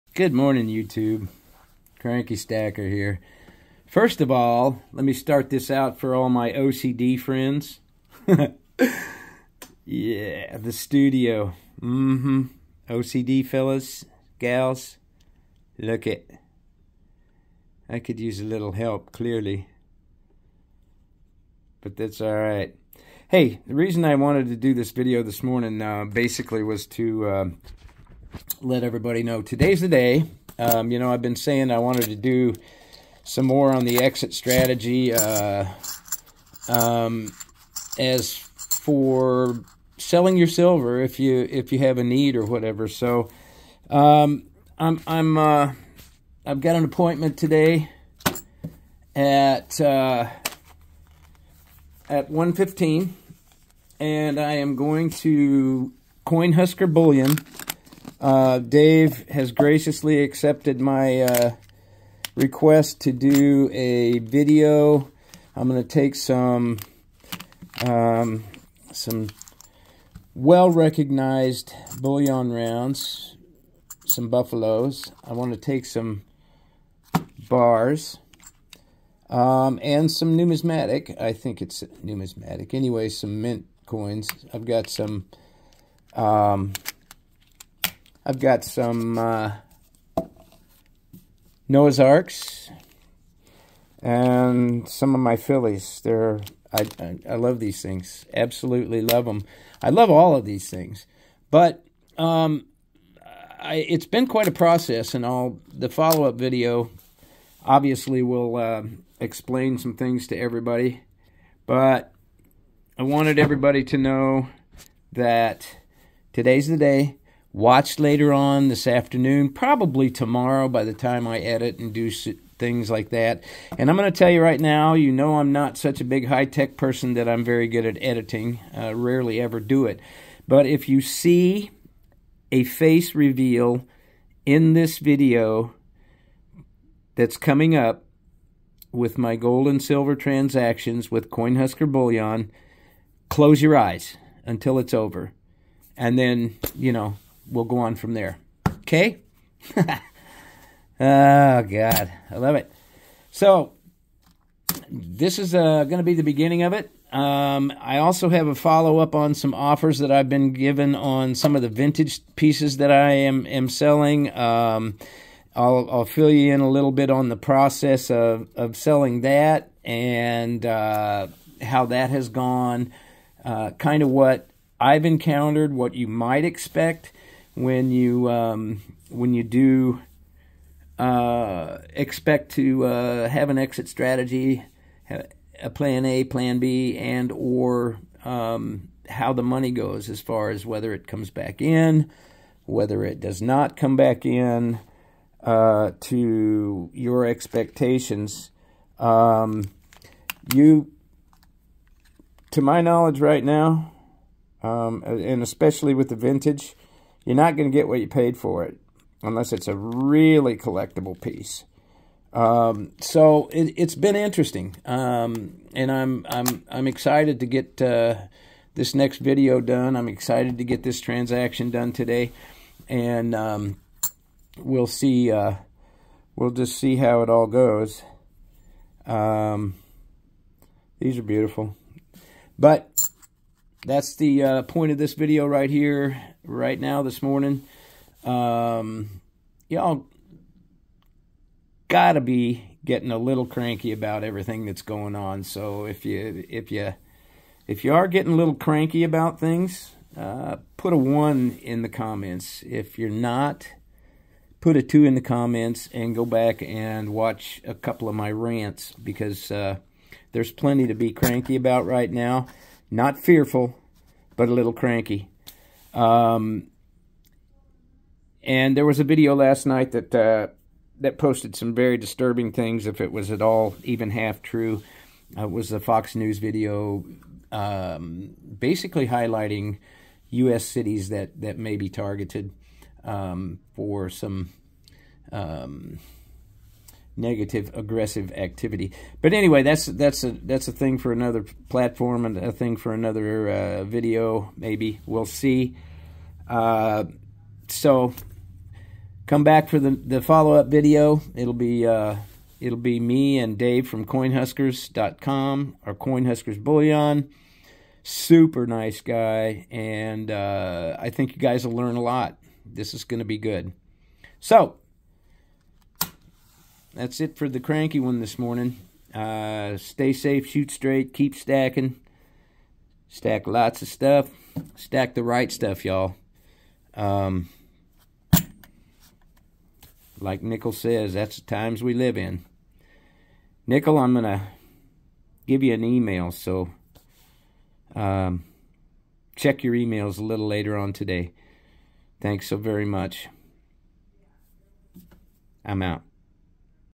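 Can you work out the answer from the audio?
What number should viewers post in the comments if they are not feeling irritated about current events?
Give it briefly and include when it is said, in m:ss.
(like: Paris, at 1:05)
2, at 4:14.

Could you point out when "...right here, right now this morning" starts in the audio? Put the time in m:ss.
3:55.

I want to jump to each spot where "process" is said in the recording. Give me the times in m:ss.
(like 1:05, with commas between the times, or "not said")
1:44, 2:47.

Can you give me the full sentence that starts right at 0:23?
Hey, the reason I wanted to do this video this morning uh, basically was to...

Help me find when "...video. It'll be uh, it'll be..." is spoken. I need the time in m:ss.
5:00.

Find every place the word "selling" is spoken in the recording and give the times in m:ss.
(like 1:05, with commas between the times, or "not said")
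0:39, 2:43, 2:48.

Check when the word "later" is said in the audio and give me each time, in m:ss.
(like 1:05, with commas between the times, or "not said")
1:57, 5:40.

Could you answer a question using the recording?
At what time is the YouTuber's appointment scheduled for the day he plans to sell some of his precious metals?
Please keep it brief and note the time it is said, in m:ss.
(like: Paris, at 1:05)
1:15, at 0:52.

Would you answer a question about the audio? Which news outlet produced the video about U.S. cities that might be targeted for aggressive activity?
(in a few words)
Fox News.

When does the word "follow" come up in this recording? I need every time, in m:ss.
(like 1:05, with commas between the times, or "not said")
1:45, 2:38, 5:00.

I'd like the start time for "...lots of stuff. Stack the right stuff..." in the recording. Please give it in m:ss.
5:23.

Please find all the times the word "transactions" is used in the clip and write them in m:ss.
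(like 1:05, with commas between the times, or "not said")
2:20, 3:41.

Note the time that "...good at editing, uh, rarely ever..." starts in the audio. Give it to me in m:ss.
2:07.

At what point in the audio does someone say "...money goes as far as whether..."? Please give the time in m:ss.
3:09.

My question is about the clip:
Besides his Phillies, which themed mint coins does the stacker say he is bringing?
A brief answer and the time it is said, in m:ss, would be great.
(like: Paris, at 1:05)
Noah's Arks, at 1:31.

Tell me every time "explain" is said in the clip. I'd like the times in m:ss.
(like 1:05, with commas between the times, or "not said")
1:49.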